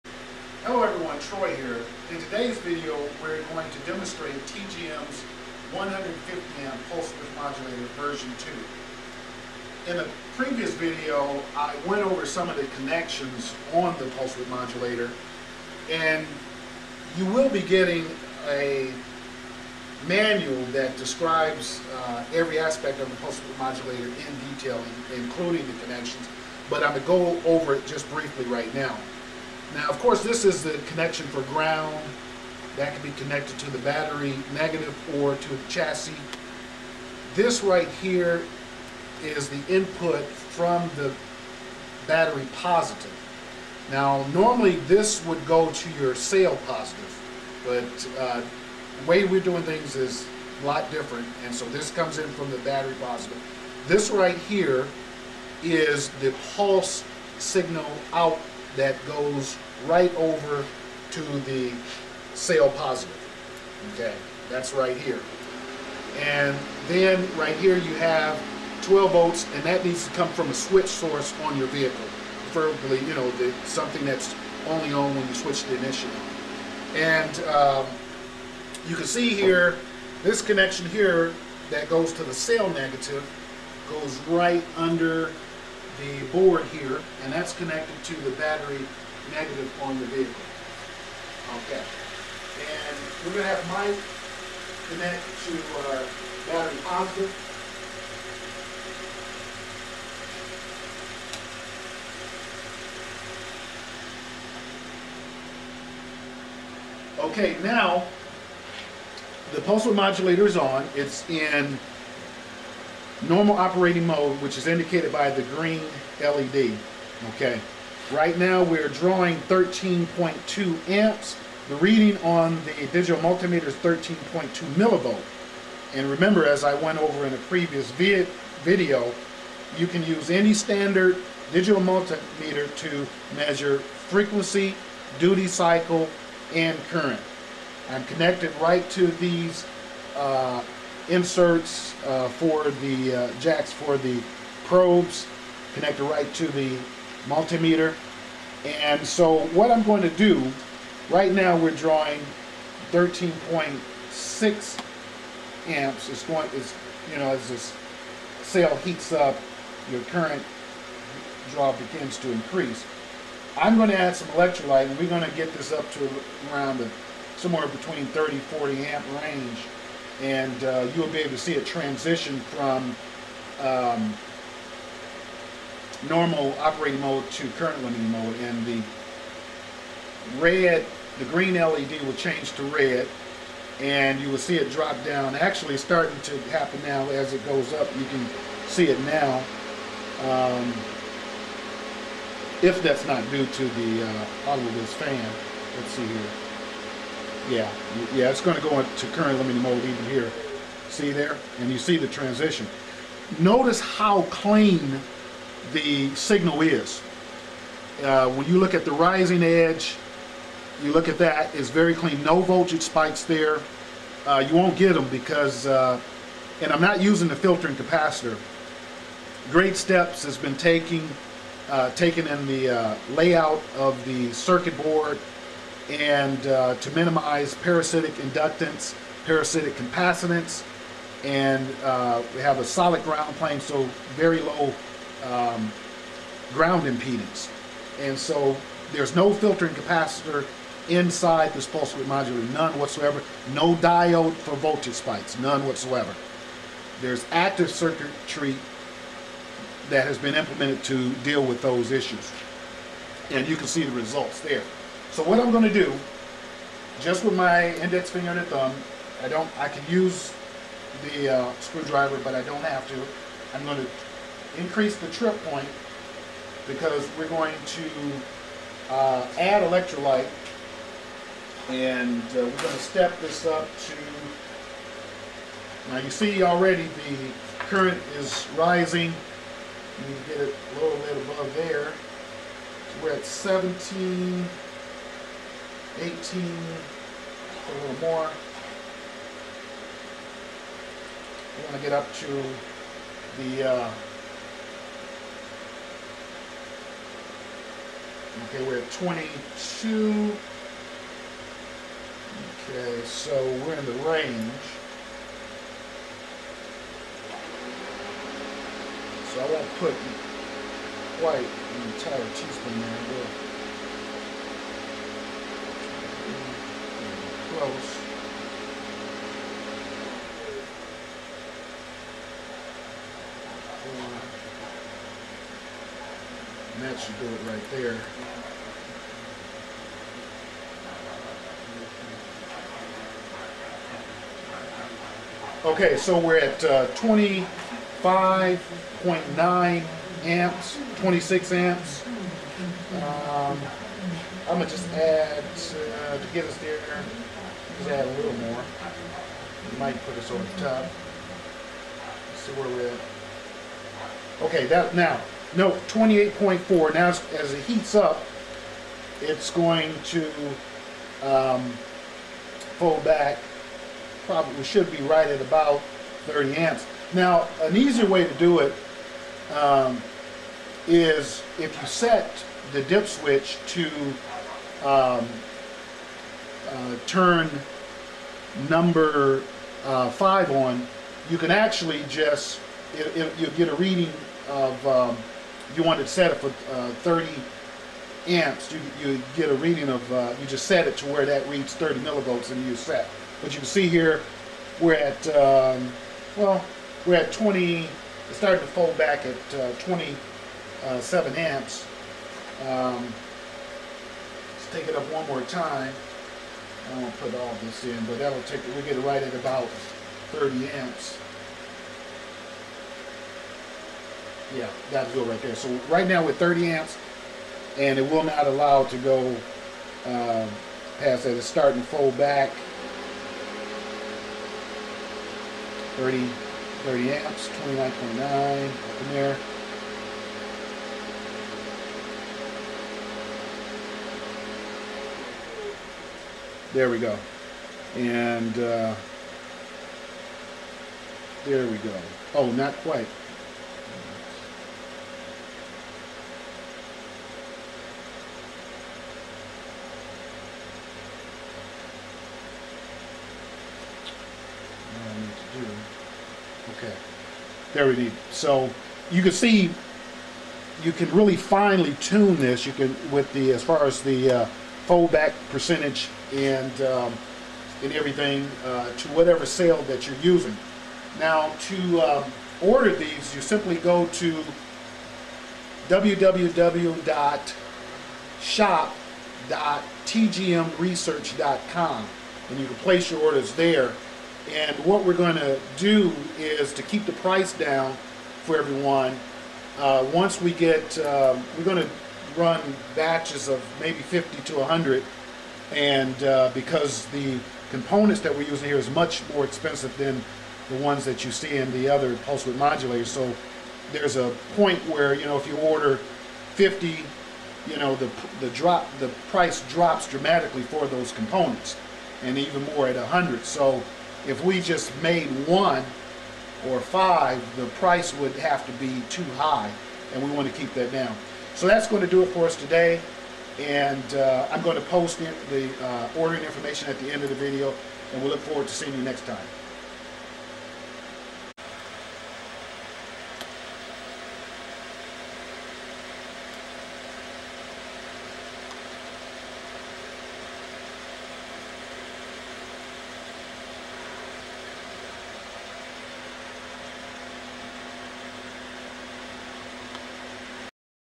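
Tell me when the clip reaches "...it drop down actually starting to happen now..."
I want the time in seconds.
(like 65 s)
184 s.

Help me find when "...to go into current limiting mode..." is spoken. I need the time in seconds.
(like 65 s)
198 s.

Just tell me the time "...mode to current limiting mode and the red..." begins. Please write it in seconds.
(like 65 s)
177 s.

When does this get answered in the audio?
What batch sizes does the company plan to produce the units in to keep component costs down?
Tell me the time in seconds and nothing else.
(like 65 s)
493 s.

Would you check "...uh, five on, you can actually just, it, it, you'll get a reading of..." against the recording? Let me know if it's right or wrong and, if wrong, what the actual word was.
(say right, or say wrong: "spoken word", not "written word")
right.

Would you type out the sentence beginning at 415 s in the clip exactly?
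So right now we're 30 amps, and it will not allow to go uh, past that.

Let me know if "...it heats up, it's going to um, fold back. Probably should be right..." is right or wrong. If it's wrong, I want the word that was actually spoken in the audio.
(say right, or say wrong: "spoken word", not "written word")
right.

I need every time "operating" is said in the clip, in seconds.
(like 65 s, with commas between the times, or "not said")
113 s, 176 s.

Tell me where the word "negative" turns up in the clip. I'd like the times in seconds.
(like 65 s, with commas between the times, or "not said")
34 s, 82 s, 89 s.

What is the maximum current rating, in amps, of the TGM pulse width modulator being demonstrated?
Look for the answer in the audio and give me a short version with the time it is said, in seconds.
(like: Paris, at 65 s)
150 amps, at 5 s.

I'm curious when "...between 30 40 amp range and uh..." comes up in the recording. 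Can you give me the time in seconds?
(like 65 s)
167 s.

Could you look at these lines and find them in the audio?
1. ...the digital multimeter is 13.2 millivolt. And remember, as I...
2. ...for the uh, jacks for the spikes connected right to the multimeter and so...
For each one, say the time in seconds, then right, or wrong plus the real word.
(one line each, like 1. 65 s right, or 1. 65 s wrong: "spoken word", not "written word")
1. 122 s right
2. 142 s wrong: "probes", not "spikes".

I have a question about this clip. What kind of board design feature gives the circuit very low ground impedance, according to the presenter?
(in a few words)
Solid ground plane.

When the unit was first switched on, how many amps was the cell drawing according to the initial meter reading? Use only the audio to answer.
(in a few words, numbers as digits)
13.2 amps.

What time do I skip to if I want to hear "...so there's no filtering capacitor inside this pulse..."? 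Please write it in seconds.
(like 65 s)
238 s.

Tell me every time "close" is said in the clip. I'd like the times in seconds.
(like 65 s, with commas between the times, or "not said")
317 s.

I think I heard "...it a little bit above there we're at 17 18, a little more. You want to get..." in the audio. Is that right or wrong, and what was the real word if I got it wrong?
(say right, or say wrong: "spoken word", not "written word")
right.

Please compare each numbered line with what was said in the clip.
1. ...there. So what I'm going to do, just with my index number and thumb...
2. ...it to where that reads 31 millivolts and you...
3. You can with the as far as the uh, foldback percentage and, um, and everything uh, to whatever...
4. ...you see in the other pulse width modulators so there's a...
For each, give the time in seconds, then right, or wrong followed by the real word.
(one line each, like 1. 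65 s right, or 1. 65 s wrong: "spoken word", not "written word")
1. 254 s wrong: "finger", not "number"
2. 390 s wrong: "30", not "31"
3. 462 s right
4. 501 s right.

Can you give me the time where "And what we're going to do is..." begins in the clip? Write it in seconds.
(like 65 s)
484 s.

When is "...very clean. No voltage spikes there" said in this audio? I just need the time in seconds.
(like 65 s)
211 s.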